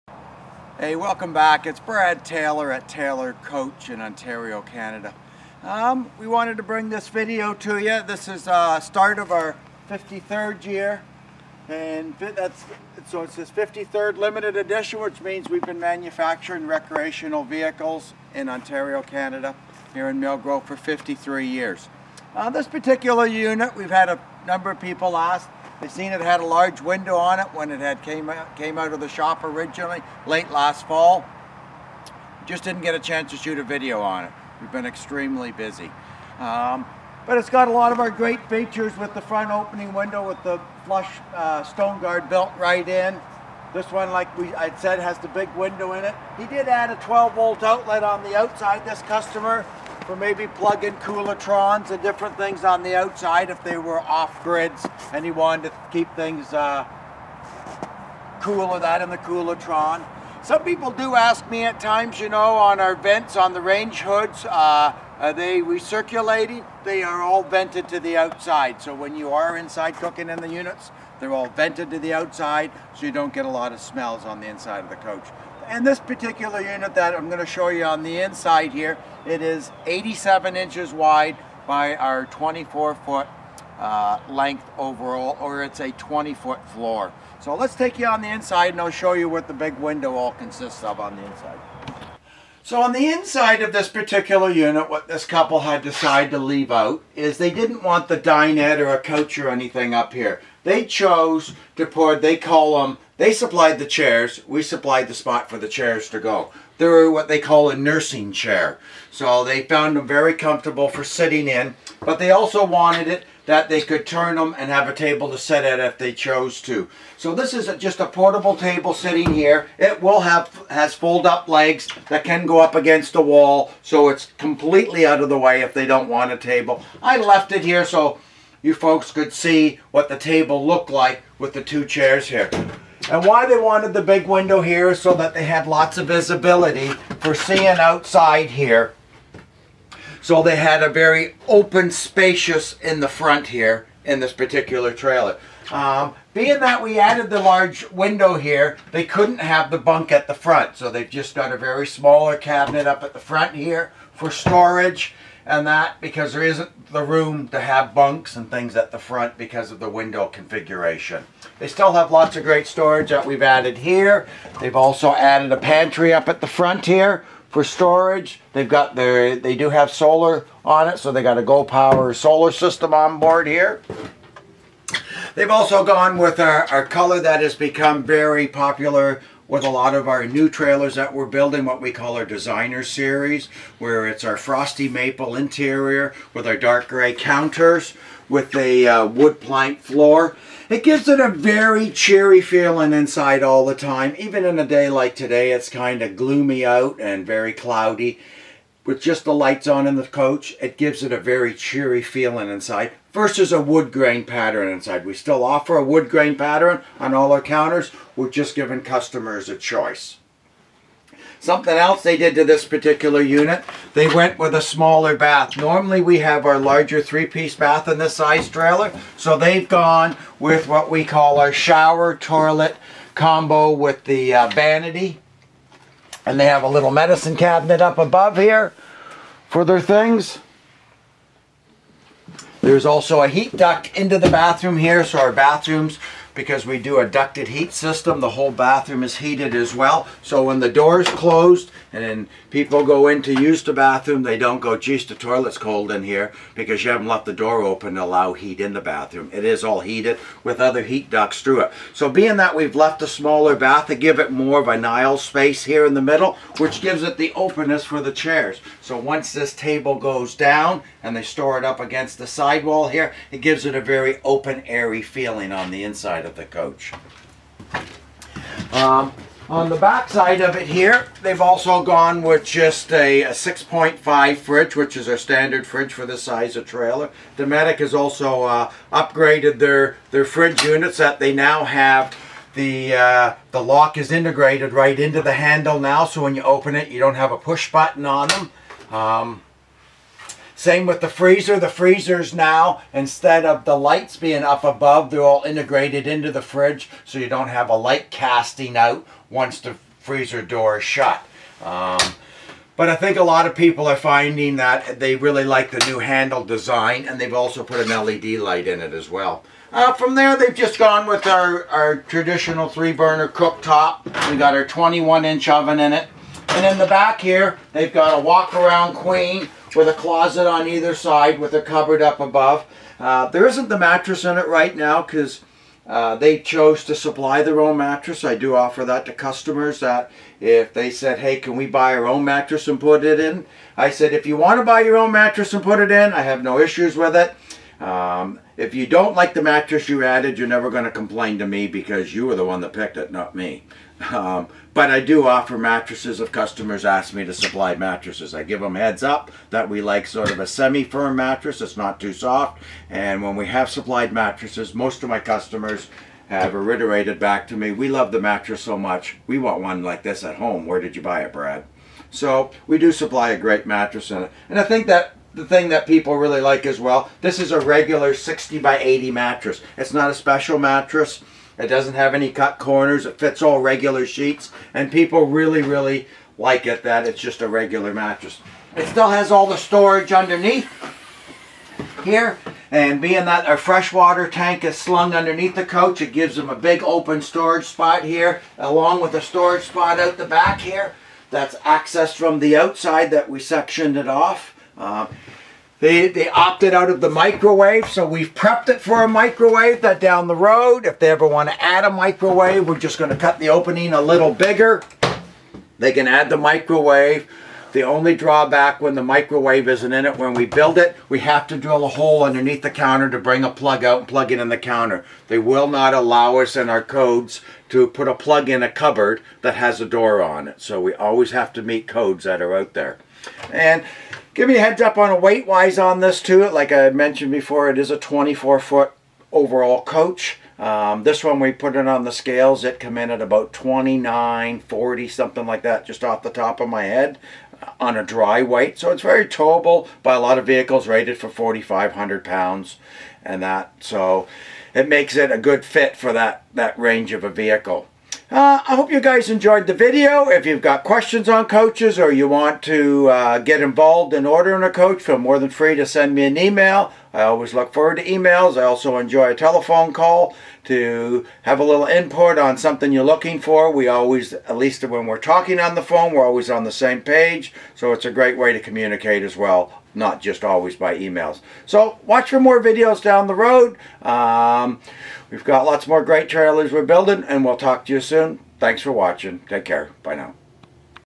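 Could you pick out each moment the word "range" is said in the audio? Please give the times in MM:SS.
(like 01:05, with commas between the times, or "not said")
01:03, 07:26.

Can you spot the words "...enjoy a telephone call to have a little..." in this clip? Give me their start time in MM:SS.
07:38.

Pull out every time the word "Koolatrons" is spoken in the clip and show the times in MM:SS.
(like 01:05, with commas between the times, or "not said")
00:50, 00:59.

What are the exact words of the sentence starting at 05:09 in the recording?
Uh, from there, they've just gone with our, our traditional three-burner cooktop.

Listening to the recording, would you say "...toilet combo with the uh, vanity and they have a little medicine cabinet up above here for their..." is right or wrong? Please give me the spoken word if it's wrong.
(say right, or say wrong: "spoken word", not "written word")
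right.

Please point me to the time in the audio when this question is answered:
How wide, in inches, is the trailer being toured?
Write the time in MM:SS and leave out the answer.
01:19.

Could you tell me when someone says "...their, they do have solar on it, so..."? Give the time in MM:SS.
02:48.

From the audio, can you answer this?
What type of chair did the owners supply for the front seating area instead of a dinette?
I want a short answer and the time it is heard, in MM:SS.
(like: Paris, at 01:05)
nursing chair, at 01:47.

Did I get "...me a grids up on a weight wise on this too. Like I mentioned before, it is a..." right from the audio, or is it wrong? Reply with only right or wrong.
wrong.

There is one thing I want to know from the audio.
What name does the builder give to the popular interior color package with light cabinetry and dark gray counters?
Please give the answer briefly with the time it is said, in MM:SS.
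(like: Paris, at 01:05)
designer series, at 03:02.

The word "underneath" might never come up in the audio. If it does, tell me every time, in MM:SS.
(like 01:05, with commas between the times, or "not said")
06:20, 06:25, 06:52.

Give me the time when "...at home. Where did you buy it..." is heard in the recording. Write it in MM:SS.
06:00.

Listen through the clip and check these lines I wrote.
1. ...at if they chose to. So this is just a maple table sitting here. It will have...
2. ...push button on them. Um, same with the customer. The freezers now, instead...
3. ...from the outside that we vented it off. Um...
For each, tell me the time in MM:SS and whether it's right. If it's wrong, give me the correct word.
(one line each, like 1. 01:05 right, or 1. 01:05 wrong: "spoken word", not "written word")
1. 01:55 wrong: "portable", not "maple"
2. 04:47 wrong: "freezer", not "customer"
3. 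06:32 wrong: "sectioned", not "vented".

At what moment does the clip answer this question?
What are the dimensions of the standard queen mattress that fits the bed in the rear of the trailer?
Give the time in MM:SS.
06:08.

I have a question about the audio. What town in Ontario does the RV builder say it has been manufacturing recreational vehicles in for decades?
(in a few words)
Millgrove.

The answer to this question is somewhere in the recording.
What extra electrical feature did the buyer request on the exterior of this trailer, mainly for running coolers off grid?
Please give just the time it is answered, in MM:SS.
00:47.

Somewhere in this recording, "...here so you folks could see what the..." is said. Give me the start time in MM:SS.
02:07.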